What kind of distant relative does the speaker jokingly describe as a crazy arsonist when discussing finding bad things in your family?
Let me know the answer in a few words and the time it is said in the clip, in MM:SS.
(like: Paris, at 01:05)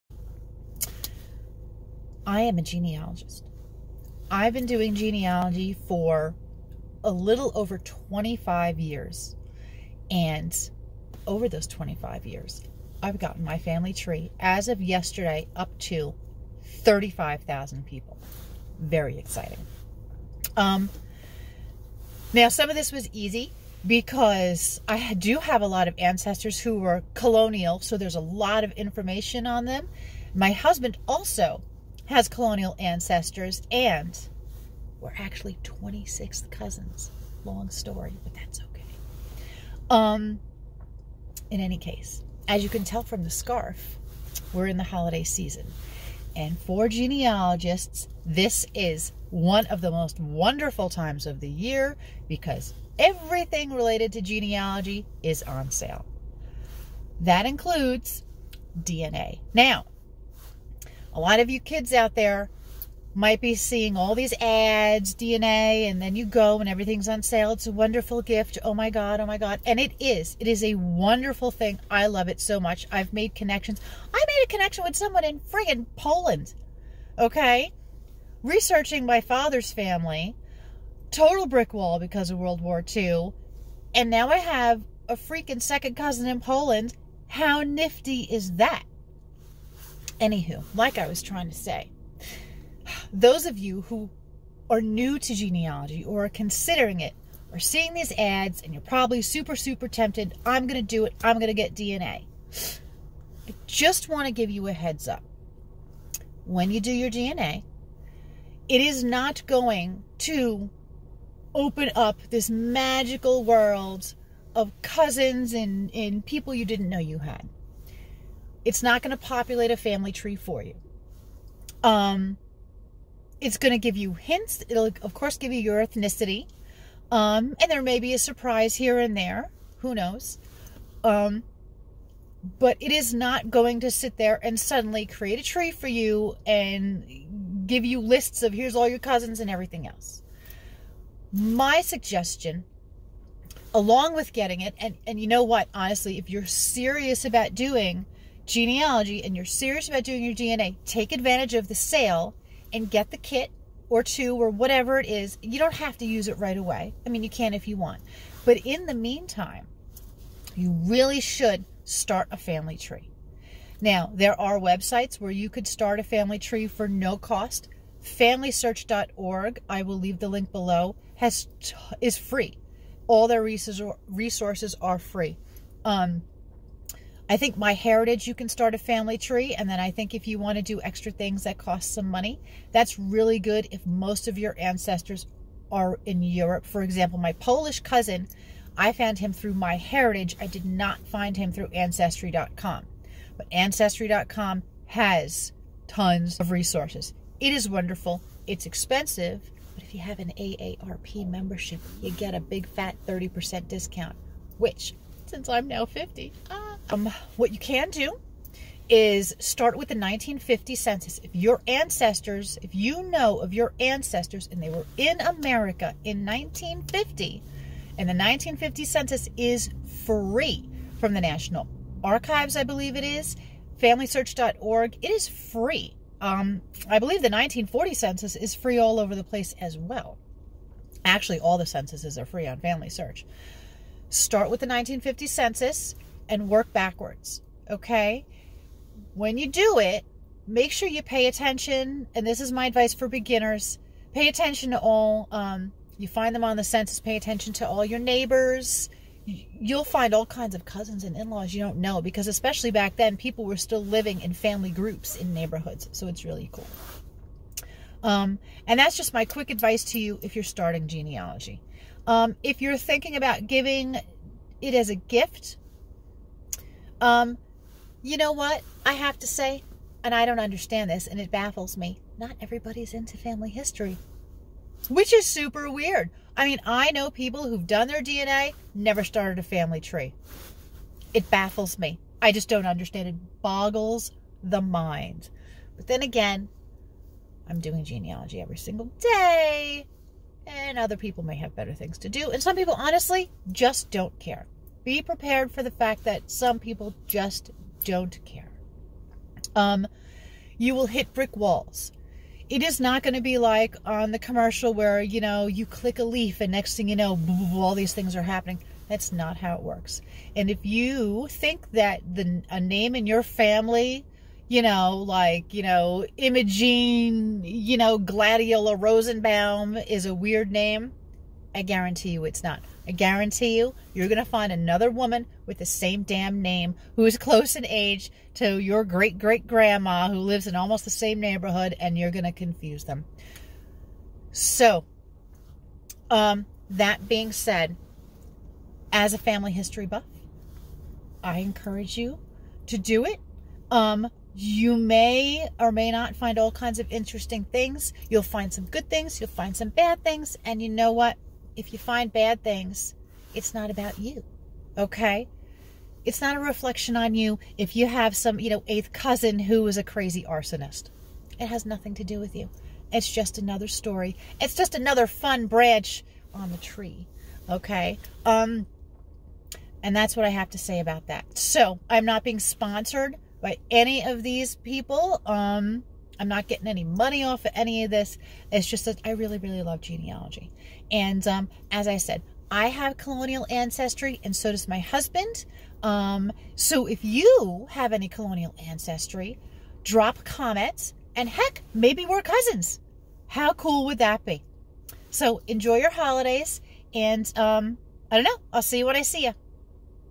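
eighth cousin, at 05:58.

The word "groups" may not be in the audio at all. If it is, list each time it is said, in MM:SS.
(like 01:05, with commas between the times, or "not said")
04:14.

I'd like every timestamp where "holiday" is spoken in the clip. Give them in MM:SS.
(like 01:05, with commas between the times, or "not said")
00:44, 06:35.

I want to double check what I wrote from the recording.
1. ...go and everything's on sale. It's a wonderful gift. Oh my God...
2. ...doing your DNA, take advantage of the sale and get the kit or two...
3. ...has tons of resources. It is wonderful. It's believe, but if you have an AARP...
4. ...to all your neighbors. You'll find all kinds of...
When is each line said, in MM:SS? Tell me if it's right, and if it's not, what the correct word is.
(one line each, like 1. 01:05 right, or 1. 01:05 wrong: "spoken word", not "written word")
1. 01:06 right
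2. 02:30 right
3. 03:14 wrong: "expensive", not "believe"
4. 04:07 right.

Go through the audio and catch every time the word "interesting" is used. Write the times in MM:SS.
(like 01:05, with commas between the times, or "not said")
05:46.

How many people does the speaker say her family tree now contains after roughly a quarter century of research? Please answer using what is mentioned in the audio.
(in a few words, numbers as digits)
35,000.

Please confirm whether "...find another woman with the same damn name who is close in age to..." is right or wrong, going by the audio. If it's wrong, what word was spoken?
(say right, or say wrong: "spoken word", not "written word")
right.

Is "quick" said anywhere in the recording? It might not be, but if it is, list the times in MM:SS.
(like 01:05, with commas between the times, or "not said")
04:19.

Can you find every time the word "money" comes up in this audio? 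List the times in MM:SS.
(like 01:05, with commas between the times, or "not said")
03:02, 06:16.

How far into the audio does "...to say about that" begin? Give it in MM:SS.
06:10.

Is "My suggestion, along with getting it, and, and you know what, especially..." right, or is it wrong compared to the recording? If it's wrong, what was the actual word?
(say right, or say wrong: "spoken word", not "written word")
wrong: "honestly", not "especially".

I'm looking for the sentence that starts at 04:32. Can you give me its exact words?
Not everybody's into family history, which is super weird.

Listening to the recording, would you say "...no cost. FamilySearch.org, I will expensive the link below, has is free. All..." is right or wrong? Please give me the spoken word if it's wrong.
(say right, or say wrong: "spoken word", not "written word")
wrong: "leave", not "expensive".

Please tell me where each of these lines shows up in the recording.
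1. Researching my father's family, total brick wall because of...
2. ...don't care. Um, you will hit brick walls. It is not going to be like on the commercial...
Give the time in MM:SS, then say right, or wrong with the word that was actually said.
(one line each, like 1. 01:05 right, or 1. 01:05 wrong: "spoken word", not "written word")
1. 01:18 right
2. 04:57 right.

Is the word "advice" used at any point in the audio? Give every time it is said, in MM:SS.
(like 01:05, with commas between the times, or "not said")
04:02, 04:19.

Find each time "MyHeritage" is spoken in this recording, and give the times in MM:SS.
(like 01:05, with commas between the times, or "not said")
02:57, 03:09.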